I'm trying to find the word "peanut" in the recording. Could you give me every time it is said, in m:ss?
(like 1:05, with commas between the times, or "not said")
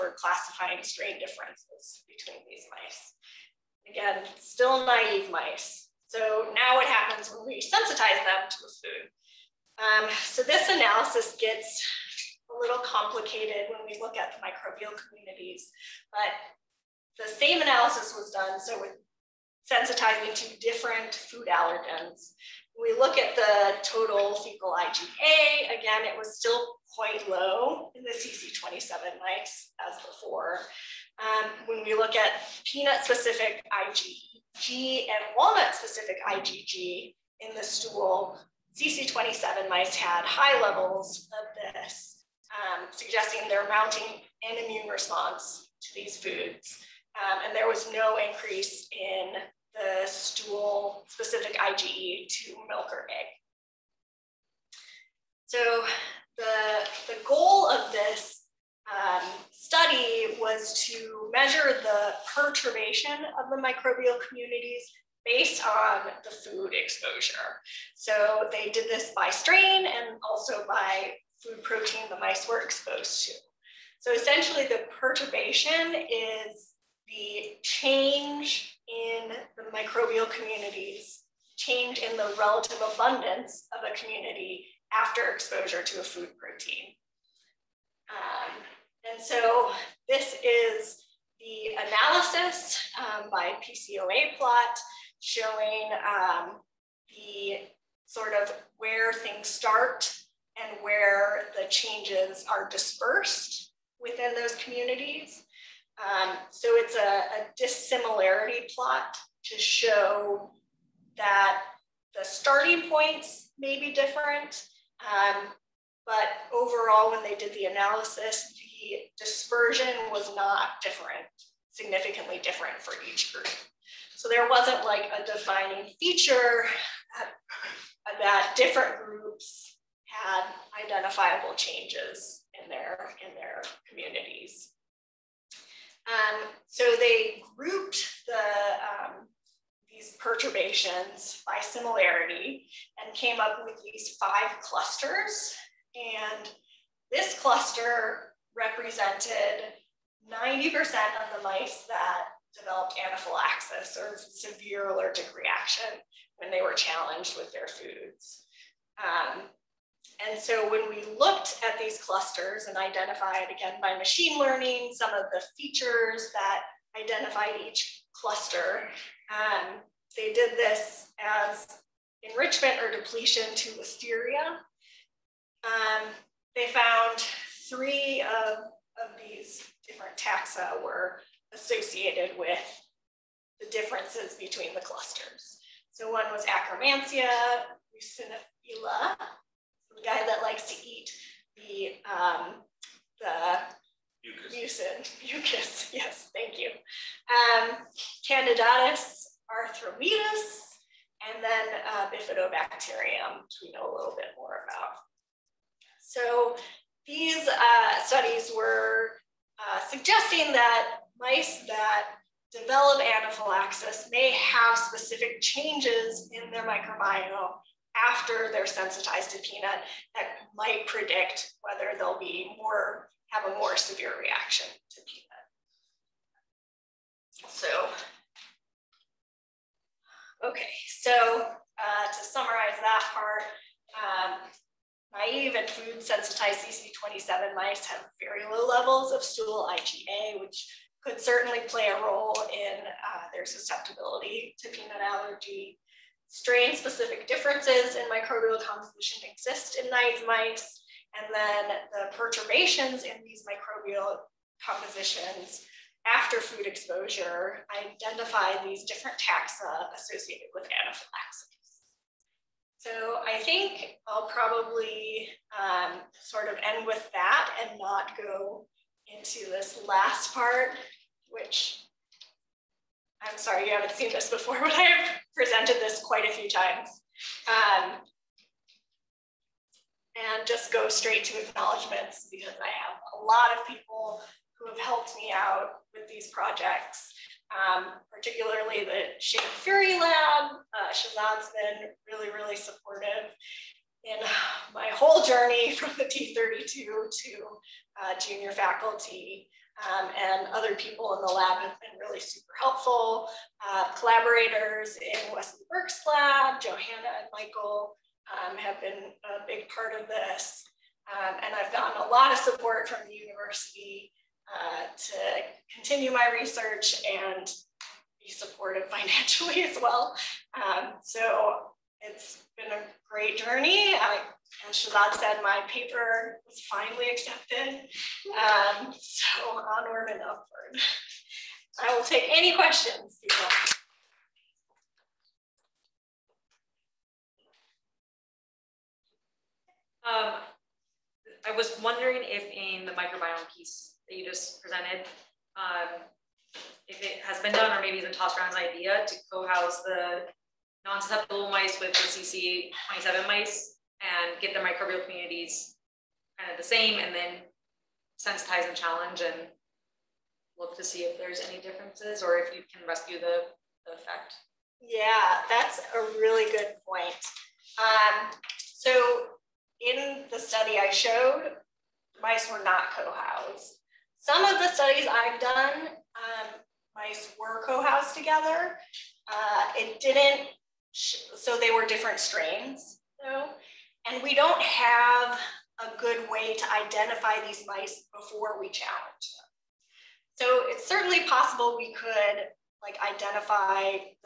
0:32, 3:39, 3:45, 4:04.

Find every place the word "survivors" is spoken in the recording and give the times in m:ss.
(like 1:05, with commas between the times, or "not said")
not said.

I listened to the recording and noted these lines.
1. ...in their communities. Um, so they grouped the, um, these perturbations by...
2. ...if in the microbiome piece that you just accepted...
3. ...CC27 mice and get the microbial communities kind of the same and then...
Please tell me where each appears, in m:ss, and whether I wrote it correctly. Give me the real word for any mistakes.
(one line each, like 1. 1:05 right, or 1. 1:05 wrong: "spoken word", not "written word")
1. 2:13 right
2. 5:42 wrong: "presented", not "accepted"
3. 5:51 right.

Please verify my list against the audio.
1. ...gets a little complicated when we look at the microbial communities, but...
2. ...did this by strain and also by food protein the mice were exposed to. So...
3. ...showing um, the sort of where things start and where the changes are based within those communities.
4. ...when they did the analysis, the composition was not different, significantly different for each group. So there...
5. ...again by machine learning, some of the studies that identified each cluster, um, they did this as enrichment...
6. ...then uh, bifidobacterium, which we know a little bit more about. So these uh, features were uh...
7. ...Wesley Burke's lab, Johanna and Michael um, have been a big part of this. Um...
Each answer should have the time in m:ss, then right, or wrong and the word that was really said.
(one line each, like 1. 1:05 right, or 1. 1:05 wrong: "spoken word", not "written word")
1. 0:11 right
2. 1:08 right
3. 1:35 wrong: "dispersed", not "based"
4. 1:57 wrong: "dispersion", not "composition"
5. 2:43 wrong: "features", not "studies"
6. 3:21 wrong: "studies", not "features"
7. 5:05 right.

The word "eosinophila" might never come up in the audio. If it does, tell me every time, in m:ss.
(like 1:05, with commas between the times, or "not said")
3:07.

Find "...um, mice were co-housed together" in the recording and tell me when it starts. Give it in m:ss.
6:15.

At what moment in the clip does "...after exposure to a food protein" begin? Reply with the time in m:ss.
1:24.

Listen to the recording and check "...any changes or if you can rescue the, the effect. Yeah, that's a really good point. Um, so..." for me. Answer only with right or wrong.
wrong.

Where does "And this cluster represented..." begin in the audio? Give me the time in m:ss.
2:25.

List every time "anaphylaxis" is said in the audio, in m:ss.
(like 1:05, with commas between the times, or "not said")
2:33, 3:33, 4:20.